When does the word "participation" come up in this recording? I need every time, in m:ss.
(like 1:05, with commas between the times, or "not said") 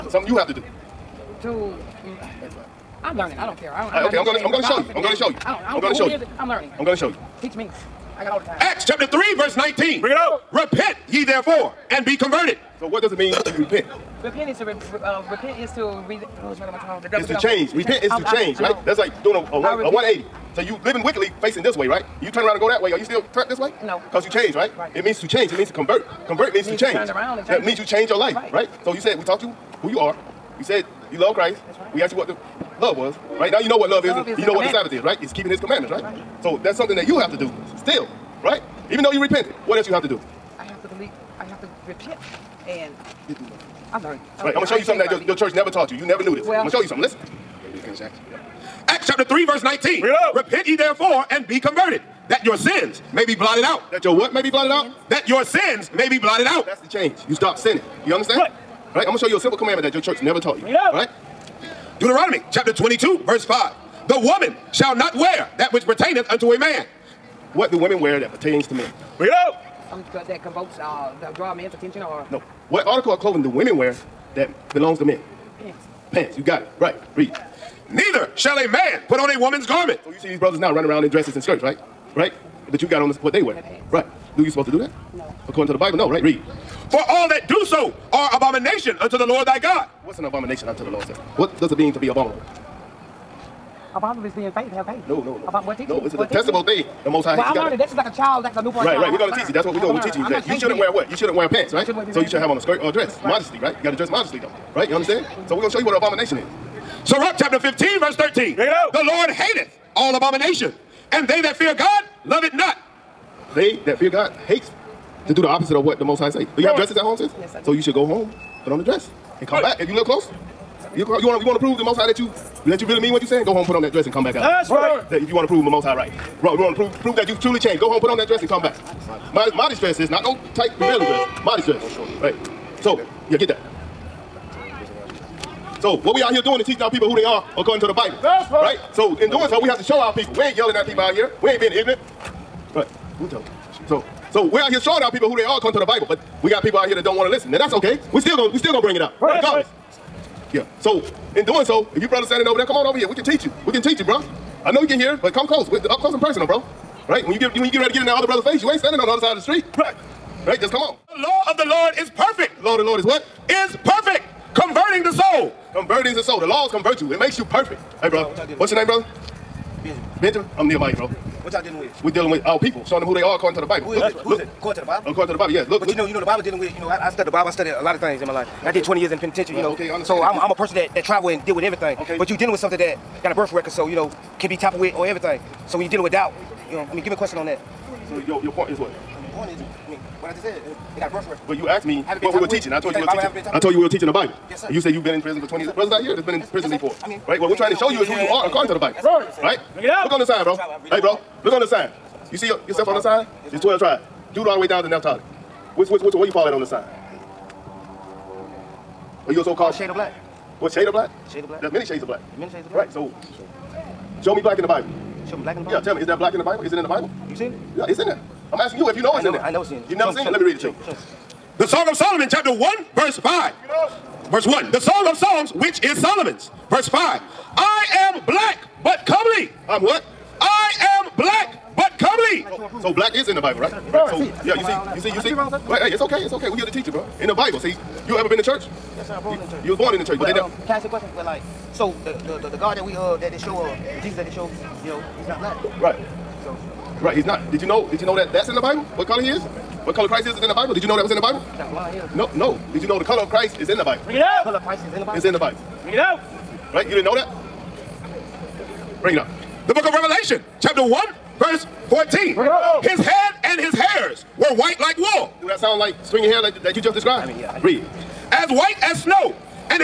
not said.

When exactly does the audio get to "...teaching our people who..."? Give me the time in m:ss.
2:16.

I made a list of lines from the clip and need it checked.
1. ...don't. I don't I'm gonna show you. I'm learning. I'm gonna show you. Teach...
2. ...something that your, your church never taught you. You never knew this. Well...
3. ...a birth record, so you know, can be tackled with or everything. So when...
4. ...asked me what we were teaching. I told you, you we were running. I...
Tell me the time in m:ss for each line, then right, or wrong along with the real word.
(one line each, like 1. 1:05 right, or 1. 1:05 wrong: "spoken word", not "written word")
1. 0:05 right
2. 0:44 right
3. 3:03 right
4. 3:11 wrong: "teaching", not "running".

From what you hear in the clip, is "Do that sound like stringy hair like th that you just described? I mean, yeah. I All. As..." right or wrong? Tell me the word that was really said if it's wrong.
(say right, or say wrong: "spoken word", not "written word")
wrong: "Read", not "All".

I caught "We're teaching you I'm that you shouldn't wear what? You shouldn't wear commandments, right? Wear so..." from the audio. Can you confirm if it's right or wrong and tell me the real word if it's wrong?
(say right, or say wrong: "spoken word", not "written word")
wrong: "pants", not "commandments".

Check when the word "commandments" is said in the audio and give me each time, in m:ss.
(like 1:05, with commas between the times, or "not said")
0:35, 0:59.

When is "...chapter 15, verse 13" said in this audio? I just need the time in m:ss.
1:47.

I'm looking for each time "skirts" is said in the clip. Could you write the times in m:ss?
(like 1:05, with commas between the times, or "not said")
1:21, 1:42.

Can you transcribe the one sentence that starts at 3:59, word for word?
You was born in the church, but, but they.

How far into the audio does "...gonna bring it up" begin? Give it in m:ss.
2:28.